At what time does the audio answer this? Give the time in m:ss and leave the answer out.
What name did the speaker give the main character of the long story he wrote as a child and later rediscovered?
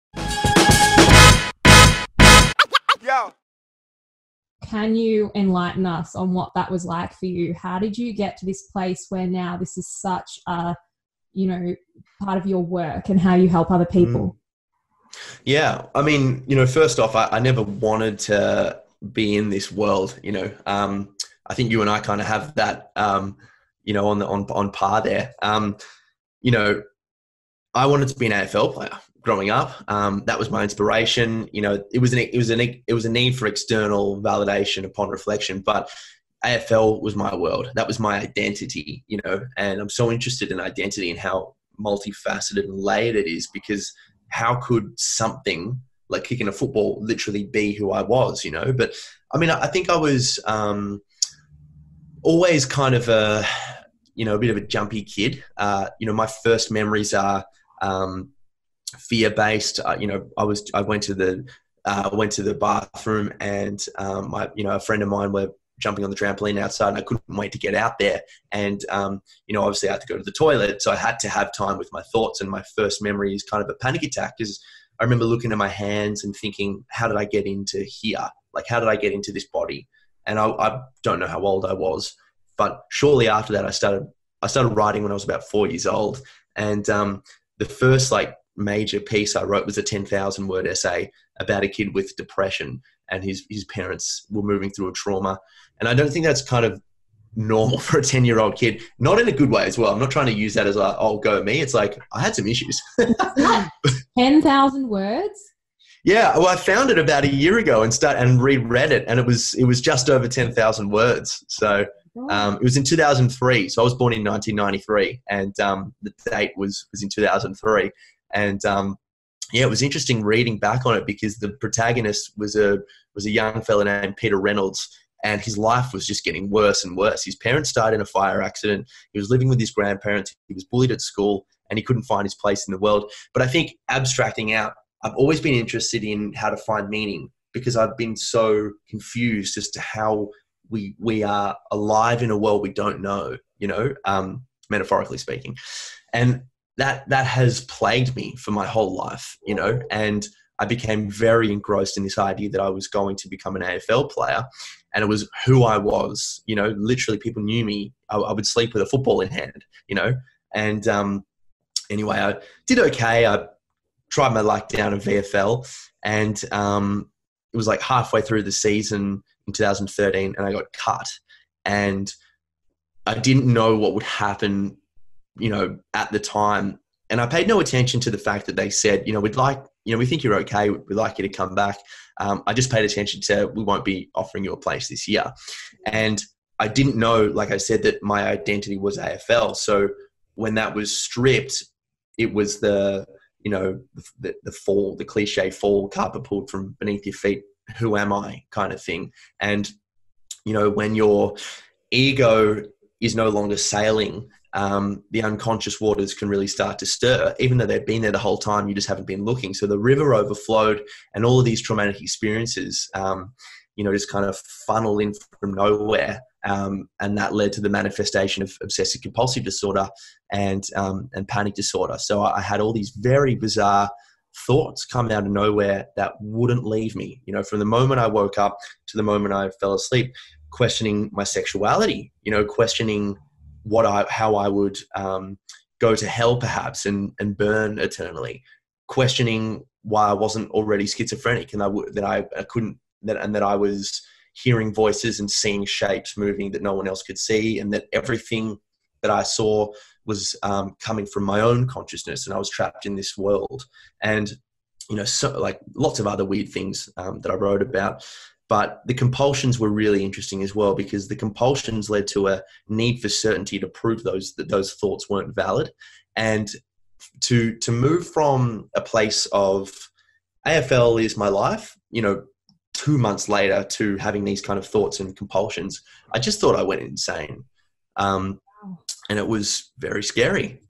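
2:04.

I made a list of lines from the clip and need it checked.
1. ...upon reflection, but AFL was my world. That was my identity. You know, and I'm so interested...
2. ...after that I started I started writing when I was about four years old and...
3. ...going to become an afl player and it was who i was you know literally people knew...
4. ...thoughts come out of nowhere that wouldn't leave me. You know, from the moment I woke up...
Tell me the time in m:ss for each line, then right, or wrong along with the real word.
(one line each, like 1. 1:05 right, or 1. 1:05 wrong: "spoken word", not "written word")
1. 0:34 right
2. 1:23 right
3. 2:32 right
4. 3:44 right.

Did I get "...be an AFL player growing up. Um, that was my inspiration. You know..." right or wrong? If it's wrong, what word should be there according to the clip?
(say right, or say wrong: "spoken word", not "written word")
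right.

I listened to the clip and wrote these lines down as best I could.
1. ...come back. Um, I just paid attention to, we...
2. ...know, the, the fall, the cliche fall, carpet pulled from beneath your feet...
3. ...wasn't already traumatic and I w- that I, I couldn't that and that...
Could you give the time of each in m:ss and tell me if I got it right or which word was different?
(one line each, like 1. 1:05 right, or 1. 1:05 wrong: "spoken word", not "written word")
1. 3:01 right
2. 3:13 right
3. 4:00 wrong: "schizophrenic", not "traumatic".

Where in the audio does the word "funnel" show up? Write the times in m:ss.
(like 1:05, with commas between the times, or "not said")
3:34.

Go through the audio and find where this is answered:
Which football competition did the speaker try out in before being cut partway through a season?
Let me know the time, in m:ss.
2:44.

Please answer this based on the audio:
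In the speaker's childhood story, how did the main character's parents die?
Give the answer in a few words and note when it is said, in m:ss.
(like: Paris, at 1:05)
Fire accident, at 2:08.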